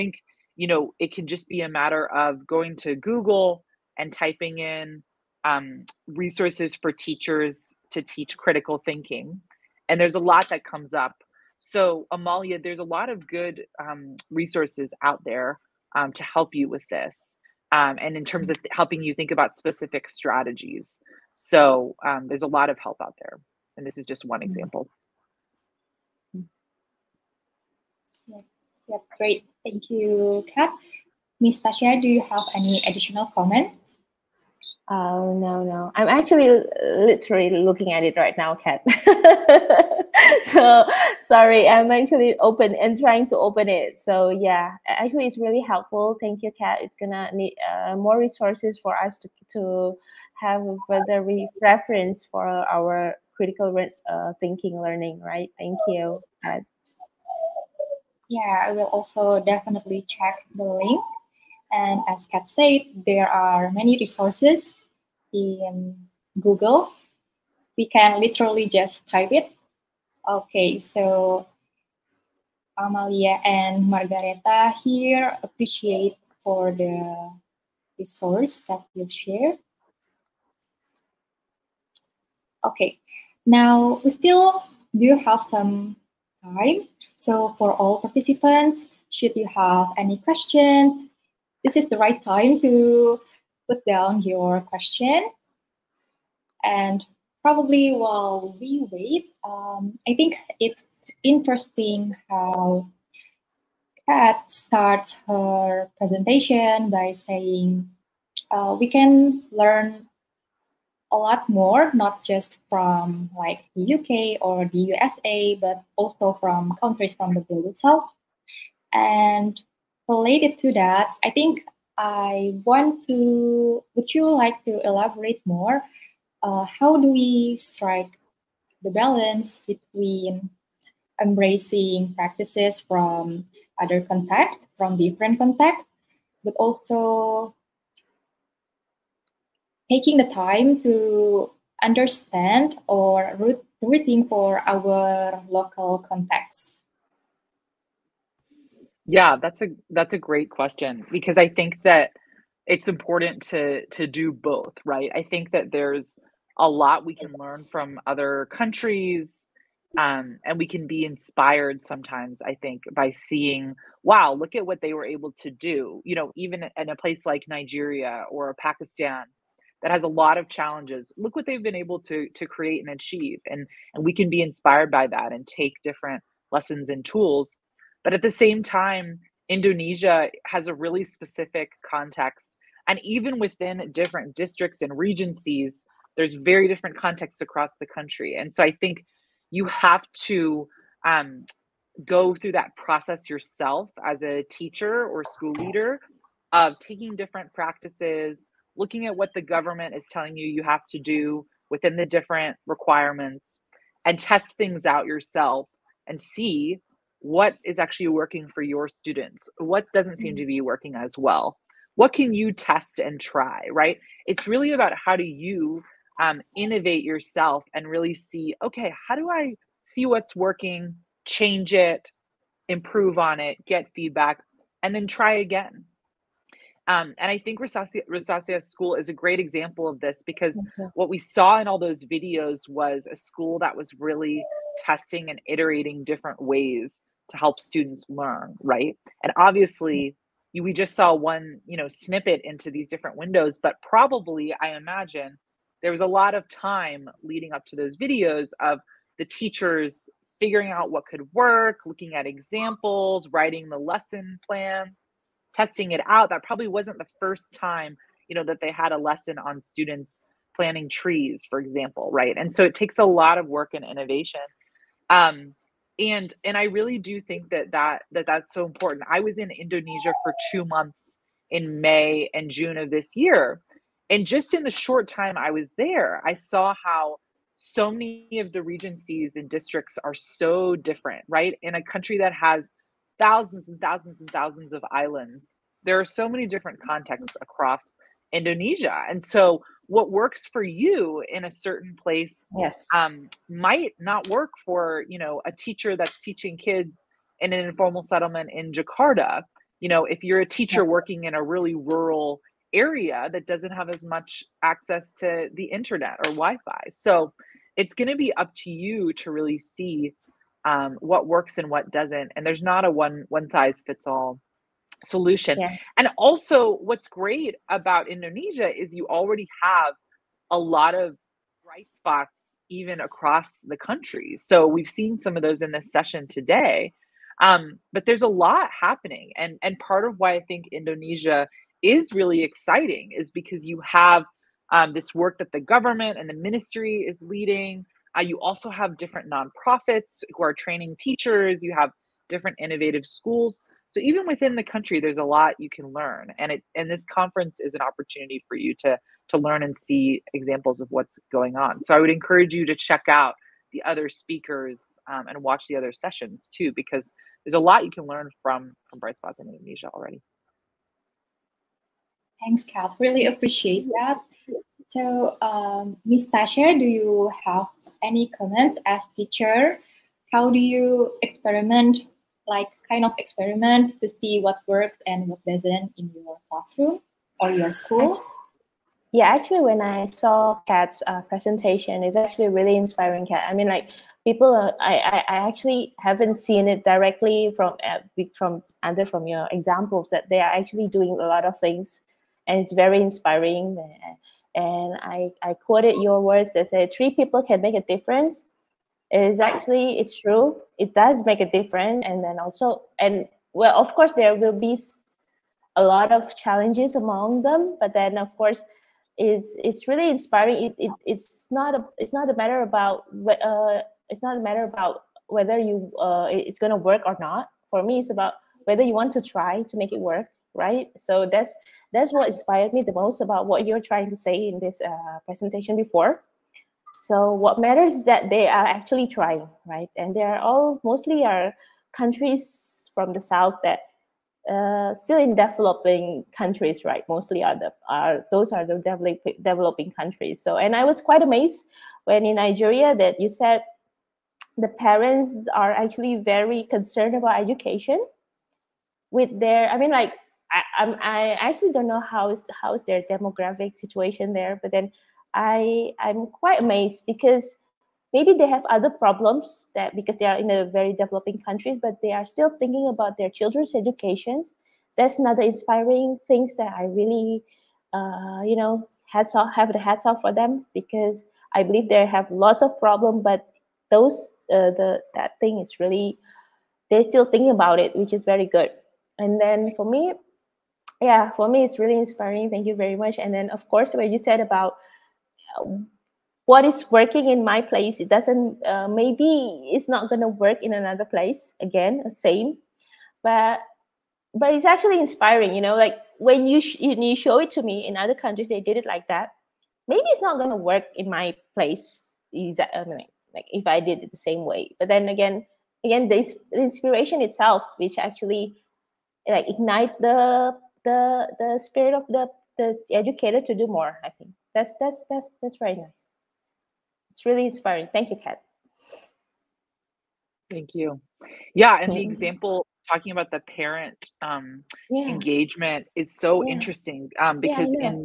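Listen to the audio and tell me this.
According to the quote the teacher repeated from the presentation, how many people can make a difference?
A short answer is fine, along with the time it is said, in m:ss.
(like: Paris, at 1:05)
3, at 6:36.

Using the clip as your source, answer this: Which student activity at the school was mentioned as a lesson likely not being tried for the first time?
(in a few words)
planting trees.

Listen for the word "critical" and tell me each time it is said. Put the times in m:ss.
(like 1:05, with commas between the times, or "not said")
0:08, 0:53.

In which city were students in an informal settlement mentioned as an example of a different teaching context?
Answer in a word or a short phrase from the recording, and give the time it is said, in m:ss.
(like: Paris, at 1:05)
Jakarta, at 4:58.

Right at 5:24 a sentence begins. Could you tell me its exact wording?
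So we've seen some of those in this session today.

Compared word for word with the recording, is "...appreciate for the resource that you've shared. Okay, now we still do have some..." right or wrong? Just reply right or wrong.
right.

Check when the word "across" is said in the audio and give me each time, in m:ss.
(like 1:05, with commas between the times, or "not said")
3:07, 4:47, 5:23.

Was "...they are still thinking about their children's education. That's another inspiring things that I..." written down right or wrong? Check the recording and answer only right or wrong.
right.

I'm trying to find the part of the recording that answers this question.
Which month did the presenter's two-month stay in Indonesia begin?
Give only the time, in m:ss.
4:31.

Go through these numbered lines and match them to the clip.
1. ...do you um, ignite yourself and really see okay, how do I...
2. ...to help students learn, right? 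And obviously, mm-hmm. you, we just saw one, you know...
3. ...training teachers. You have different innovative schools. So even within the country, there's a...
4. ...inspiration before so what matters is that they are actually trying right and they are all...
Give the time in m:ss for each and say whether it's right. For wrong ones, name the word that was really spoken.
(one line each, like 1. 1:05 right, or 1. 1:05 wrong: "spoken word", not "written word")
1. 3:35 wrong: "innovate", not "ignite"
2. 3:57 right
3. 5:40 right
4. 7:05 wrong: "presentation", not "inspiration".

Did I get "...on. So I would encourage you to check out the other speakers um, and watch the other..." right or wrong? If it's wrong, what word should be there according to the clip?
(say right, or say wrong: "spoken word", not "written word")
right.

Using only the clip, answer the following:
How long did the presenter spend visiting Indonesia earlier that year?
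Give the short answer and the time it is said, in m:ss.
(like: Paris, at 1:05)
2 months, at 4:30.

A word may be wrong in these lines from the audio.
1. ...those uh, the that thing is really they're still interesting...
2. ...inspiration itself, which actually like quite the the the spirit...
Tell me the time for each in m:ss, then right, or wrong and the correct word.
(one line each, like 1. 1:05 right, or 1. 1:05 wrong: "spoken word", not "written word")
1. 7:53 wrong: "thinking", not "interesting"
2. 8:26 wrong: "ignite", not "quite".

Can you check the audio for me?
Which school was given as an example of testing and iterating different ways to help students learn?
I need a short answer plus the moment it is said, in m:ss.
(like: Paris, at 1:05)
Rosacia School, at 3:47.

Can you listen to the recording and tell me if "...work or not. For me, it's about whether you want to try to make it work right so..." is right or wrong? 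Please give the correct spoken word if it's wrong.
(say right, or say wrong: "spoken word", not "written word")
right.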